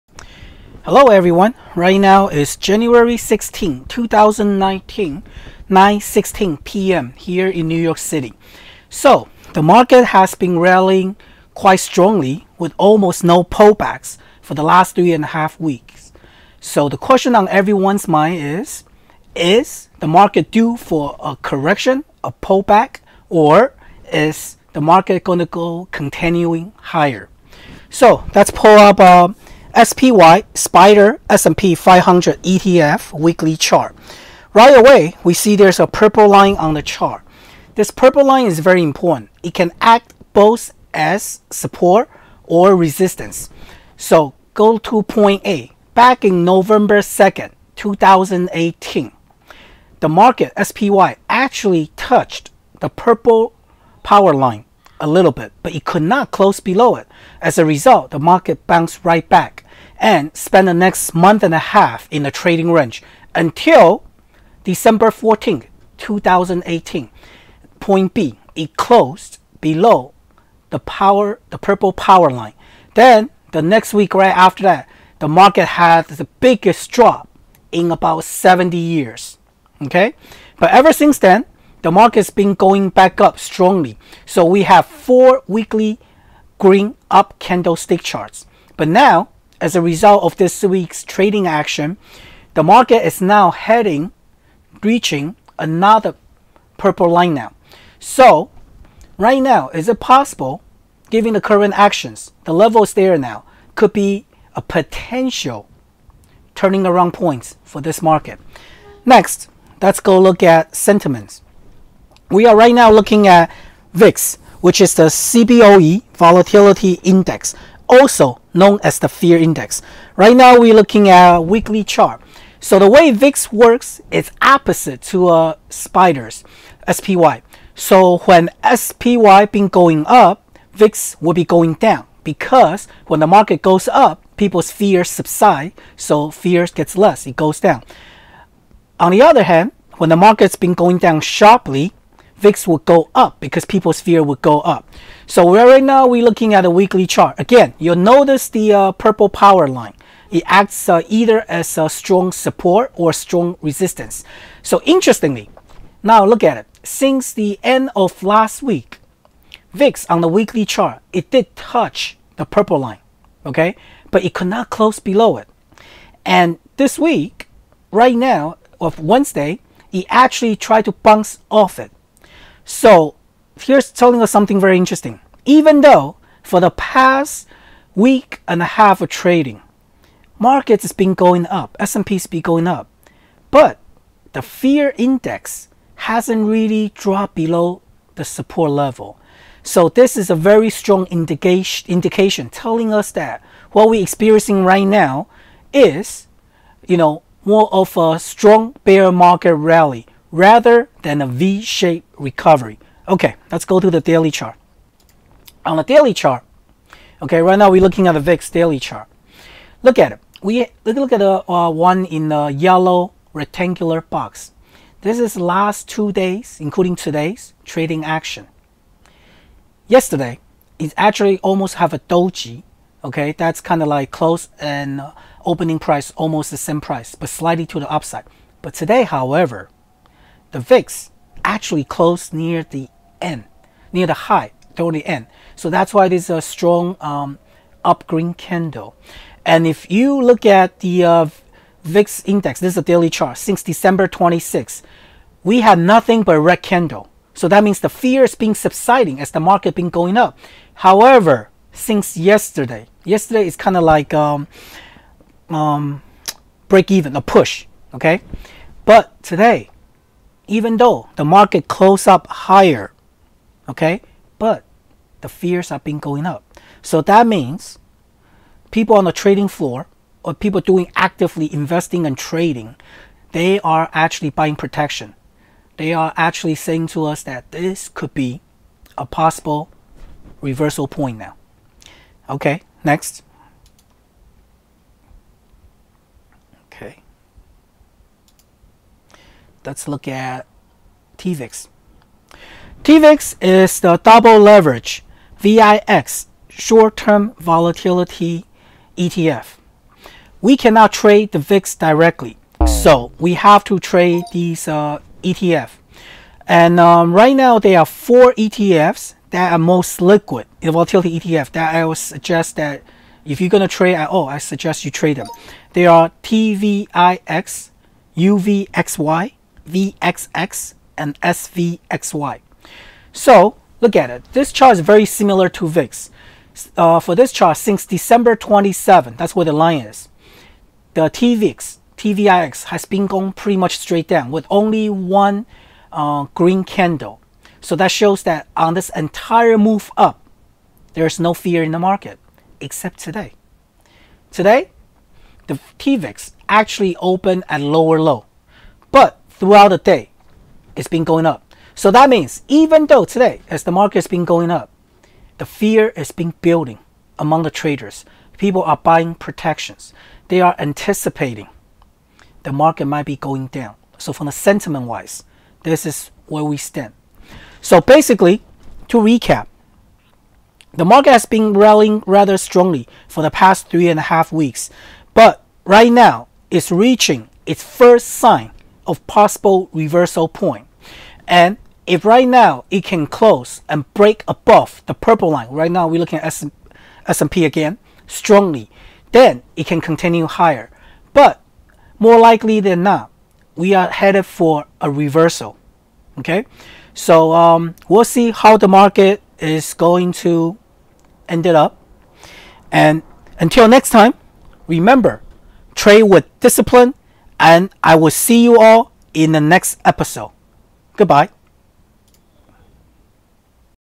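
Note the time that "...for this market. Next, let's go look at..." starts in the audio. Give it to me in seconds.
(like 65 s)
107 s.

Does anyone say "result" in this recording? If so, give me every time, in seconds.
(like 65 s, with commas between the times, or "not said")
57 s, 89 s.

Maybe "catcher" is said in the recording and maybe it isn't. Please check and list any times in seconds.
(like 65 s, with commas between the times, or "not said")
not said.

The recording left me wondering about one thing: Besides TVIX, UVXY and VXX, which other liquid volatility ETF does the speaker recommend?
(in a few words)
SVXY.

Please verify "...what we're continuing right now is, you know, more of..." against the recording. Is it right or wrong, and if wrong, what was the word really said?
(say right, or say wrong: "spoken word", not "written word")
wrong: "experiencing", not "continuing".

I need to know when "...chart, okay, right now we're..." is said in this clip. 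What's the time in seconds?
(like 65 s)
206 s.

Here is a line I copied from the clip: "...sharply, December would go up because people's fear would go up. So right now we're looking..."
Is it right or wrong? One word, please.
wrong.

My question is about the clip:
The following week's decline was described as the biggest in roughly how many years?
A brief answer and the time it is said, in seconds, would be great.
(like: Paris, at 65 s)
70, at 78 s.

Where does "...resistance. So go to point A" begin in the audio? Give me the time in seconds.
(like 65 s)
42 s.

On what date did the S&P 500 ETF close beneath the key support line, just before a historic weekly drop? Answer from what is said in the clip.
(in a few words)
December 14, 2018.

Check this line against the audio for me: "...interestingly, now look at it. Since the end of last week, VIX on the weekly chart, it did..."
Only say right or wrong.
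right.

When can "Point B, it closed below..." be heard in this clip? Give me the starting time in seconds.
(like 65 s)
67 s.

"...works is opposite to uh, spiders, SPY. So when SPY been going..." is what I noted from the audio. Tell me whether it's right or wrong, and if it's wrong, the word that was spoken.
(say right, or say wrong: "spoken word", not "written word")
right.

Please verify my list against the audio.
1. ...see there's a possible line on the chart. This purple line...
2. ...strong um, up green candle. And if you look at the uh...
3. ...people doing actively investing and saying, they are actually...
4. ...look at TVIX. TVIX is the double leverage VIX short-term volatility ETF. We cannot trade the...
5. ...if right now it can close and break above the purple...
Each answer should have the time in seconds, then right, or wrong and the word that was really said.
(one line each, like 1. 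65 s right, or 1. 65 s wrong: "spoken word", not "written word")
1. 35 s wrong: "purple", not "possible"
2. 236 s right
3. 270 s wrong: "trading", not "saying"
4. 289 s right
5. 381 s right.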